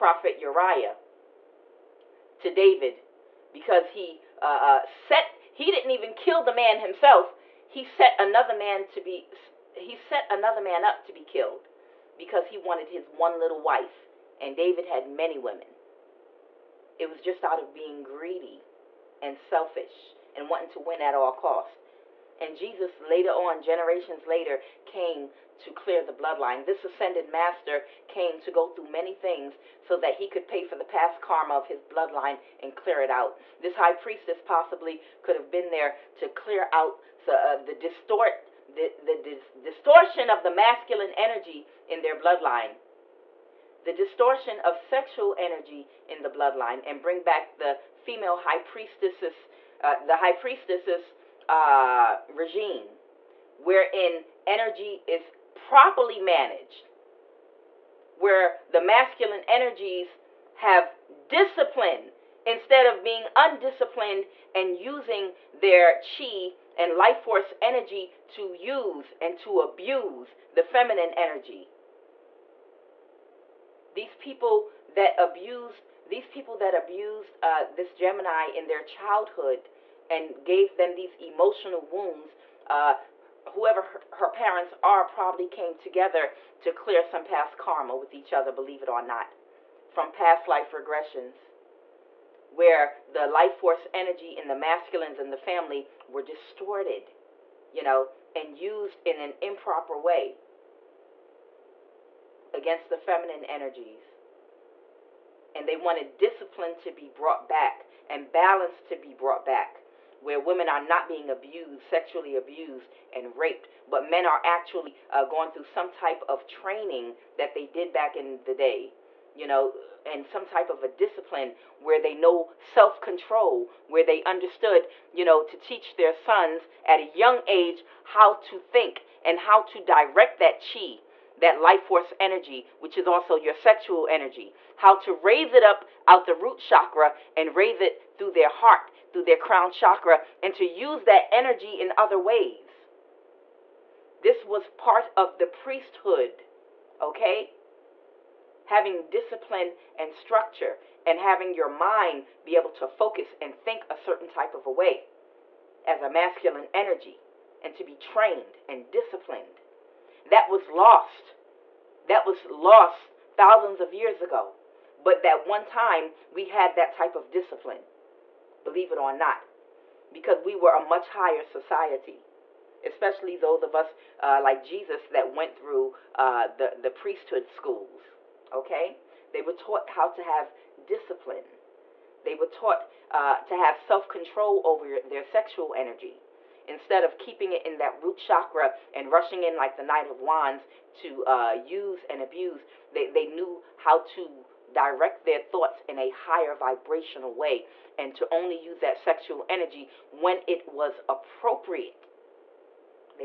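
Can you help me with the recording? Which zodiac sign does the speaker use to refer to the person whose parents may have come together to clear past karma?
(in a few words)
Gemini.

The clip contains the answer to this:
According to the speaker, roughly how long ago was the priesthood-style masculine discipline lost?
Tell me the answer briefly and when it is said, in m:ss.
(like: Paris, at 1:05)
Thousands of years ago, at 2:43.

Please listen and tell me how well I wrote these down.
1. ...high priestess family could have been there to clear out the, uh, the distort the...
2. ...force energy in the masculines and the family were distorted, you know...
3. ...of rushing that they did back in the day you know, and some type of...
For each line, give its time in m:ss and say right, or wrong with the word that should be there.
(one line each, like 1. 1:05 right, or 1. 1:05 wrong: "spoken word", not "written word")
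1. 0:33 wrong: "possibly", not "family"
2. 1:33 right
3. 1:56 wrong: "training", not "rushing".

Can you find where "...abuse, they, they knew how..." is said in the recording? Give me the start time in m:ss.
3:12.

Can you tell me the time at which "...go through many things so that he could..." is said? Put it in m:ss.
0:28.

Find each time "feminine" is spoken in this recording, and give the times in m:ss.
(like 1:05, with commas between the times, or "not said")
1:10, 1:42.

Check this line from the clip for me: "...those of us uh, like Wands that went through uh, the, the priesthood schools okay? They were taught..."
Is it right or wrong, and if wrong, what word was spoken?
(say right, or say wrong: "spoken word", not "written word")
wrong: "Jesus", not "Wands".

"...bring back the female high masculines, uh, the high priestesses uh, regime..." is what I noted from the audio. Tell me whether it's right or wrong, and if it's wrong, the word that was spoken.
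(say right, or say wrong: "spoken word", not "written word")
wrong: "priestesses", not "masculines".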